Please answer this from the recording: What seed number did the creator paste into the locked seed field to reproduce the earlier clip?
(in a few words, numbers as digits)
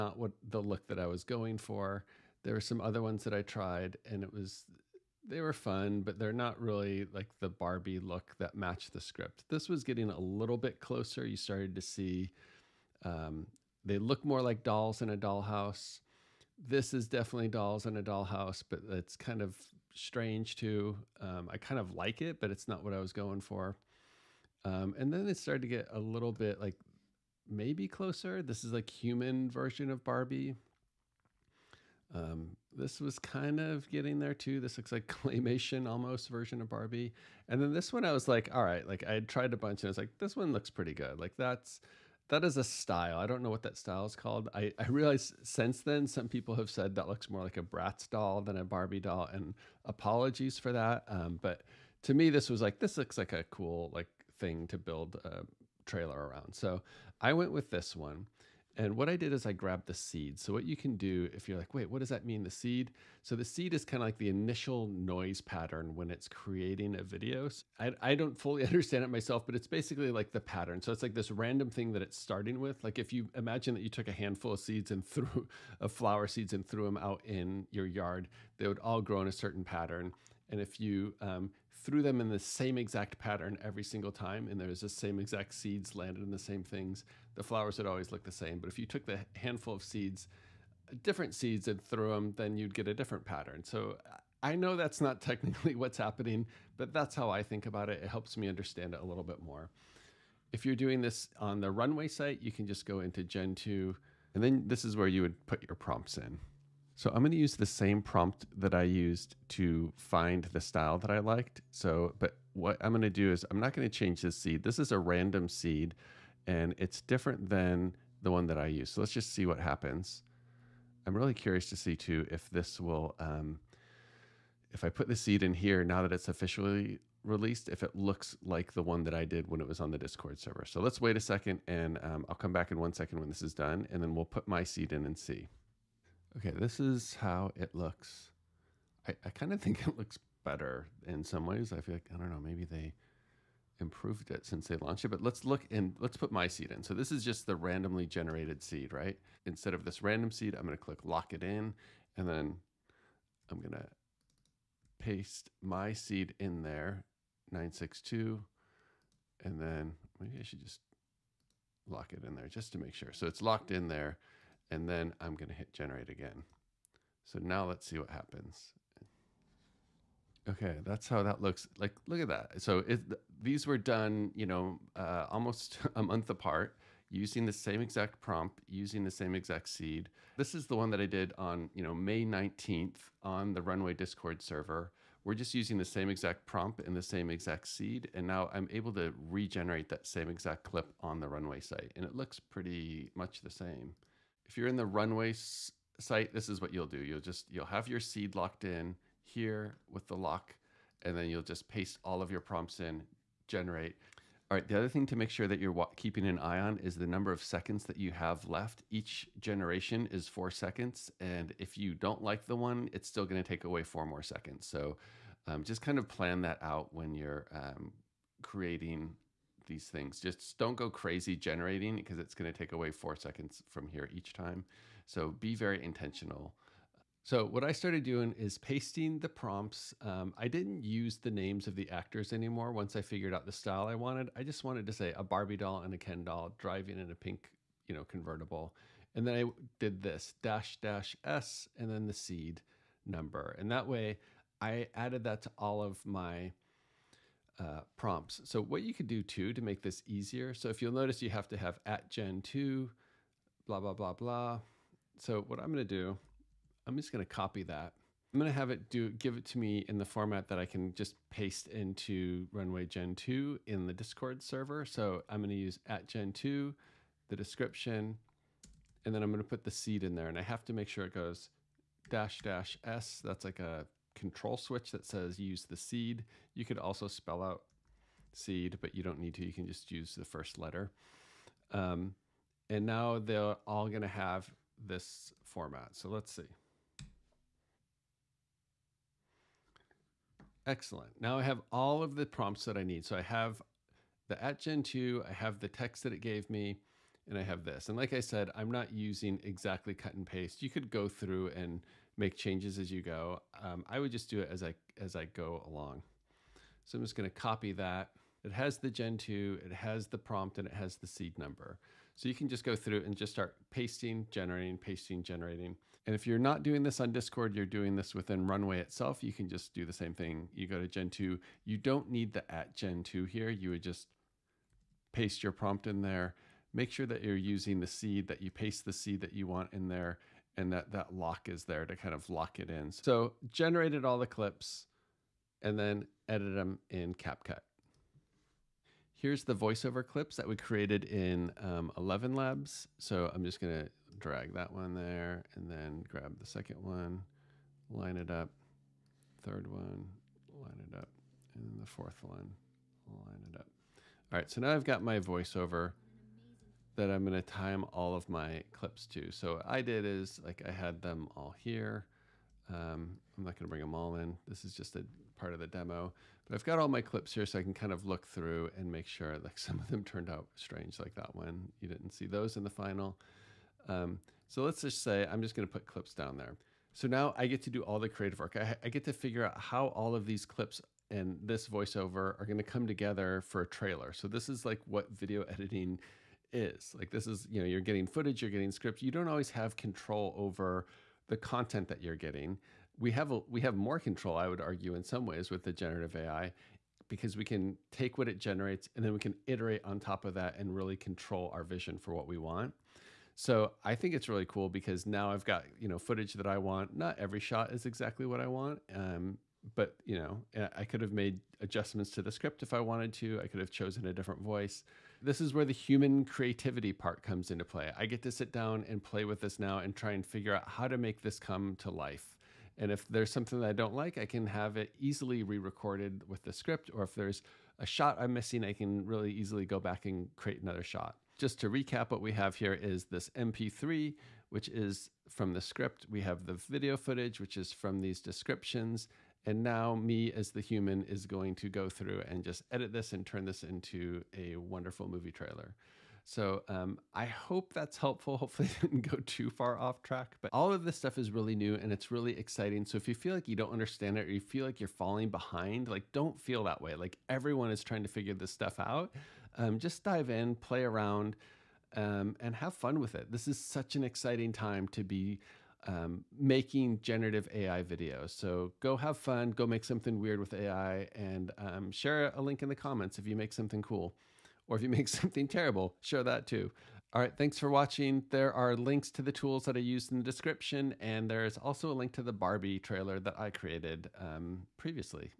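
962.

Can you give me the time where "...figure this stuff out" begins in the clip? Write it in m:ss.
7:38.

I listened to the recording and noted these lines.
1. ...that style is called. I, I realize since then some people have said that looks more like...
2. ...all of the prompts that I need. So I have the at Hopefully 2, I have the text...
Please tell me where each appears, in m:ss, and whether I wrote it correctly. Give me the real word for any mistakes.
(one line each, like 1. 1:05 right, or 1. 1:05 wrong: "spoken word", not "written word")
1. 0:43 right
2. 4:51 wrong: "Gen", not "Hopefully".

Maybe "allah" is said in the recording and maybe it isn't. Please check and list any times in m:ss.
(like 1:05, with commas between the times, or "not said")
not said.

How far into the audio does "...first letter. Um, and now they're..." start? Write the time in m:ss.
4:40.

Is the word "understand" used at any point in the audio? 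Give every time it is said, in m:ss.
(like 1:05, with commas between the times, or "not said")
1:08, 1:38, 7:33.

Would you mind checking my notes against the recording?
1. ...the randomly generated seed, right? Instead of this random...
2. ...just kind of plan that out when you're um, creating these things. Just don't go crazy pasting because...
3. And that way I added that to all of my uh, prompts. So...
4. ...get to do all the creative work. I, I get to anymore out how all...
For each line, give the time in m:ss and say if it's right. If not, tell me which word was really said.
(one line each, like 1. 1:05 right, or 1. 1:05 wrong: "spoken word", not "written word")
1. 2:27 right
2. 3:35 wrong: "generating", not "pasting"
3. 4:03 right
4. 6:17 wrong: "figure", not "anymore".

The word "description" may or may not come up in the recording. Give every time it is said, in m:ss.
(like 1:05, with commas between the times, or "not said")
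4:27, 7:18, 8:00.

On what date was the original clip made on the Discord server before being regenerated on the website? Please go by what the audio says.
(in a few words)
May 19th.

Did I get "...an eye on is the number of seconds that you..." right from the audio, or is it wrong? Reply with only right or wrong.
right.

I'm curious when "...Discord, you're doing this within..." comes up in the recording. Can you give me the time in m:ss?
5:17.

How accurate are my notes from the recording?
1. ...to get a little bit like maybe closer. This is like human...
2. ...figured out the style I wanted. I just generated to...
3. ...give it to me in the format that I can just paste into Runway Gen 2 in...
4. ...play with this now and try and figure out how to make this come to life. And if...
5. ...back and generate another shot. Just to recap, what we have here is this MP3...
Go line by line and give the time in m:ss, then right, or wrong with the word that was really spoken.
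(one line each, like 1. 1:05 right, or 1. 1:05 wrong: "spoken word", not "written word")
1. 0:25 right
2. 3:53 wrong: "wanted", not "generated"
3. 4:19 right
4. 6:59 right
5. 7:09 wrong: "create", not "generate".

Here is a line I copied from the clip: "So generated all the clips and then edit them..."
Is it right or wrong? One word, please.
right.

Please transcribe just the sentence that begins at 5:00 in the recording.
You could go through and make changes as you go.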